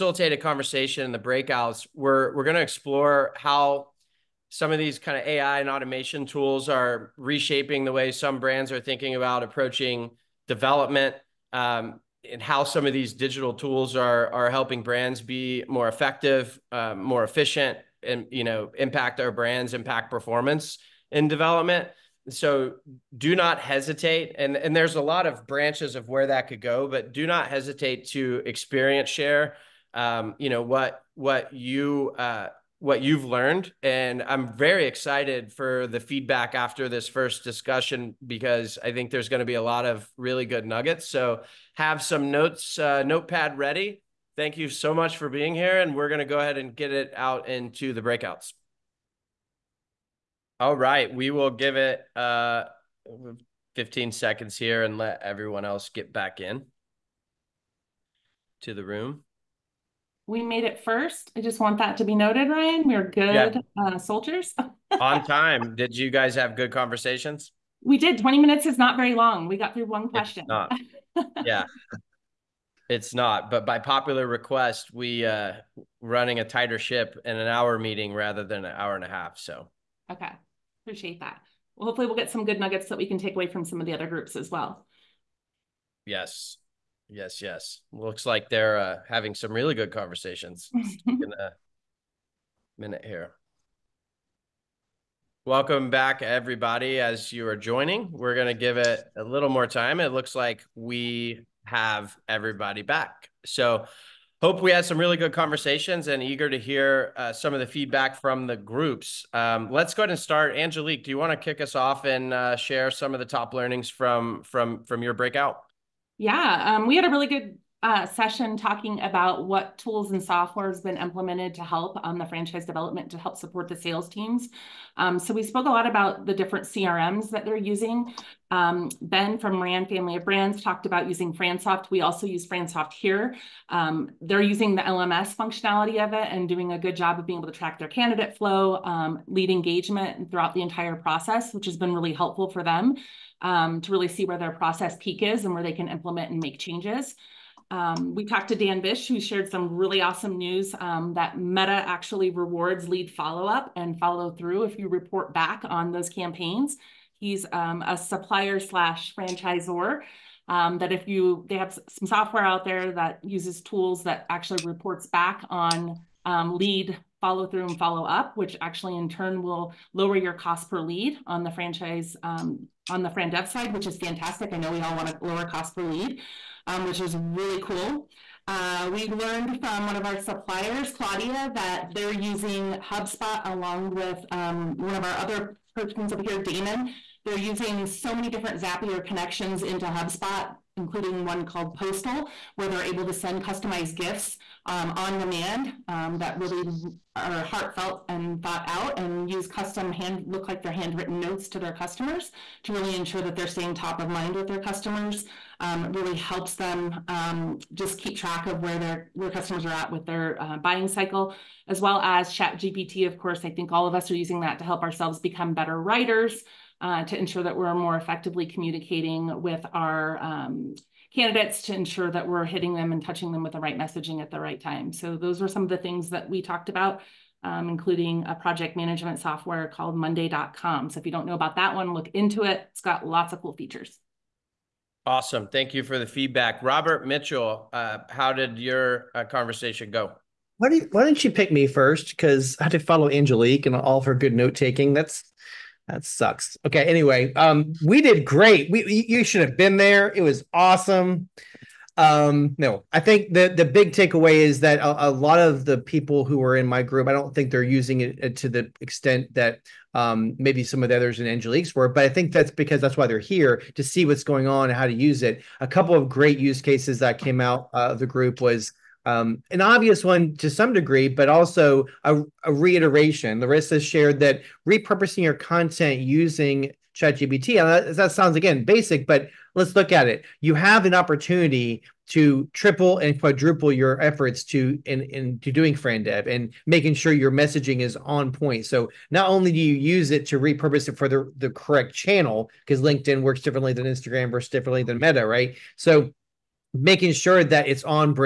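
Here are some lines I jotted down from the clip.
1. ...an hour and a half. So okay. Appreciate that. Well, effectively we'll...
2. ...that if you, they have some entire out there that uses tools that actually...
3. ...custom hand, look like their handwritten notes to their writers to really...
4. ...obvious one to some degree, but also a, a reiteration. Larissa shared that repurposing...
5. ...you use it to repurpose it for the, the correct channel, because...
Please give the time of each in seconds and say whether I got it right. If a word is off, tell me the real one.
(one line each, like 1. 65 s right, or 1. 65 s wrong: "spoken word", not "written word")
1. 78 s wrong: "hopefully", not "effectively"
2. 160 s wrong: "software", not "entire"
3. 199 s wrong: "customers", not "writers"
4. 269 s right
5. 289 s right.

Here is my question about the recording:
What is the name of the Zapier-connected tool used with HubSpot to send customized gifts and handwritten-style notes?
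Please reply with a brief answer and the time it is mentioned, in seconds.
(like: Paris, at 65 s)
Postal, at 191 s.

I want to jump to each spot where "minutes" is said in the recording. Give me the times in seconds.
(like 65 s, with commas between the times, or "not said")
68 s, 92 s.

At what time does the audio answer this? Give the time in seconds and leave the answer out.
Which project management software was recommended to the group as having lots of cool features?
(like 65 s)
229 s.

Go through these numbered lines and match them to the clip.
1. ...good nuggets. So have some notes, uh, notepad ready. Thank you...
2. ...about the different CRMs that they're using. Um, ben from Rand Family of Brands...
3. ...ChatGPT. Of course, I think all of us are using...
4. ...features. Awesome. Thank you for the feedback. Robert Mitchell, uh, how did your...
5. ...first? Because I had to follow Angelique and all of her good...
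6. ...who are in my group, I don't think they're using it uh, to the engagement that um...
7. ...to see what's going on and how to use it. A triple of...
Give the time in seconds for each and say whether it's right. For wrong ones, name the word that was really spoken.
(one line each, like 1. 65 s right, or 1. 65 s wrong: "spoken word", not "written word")
1. 40 s right
2. 125 s right
3. 212 s right
4. 233 s right
5. 241 s right
6. 256 s wrong: "extent", not "engagement"
7. 263 s wrong: "couple", not "triple".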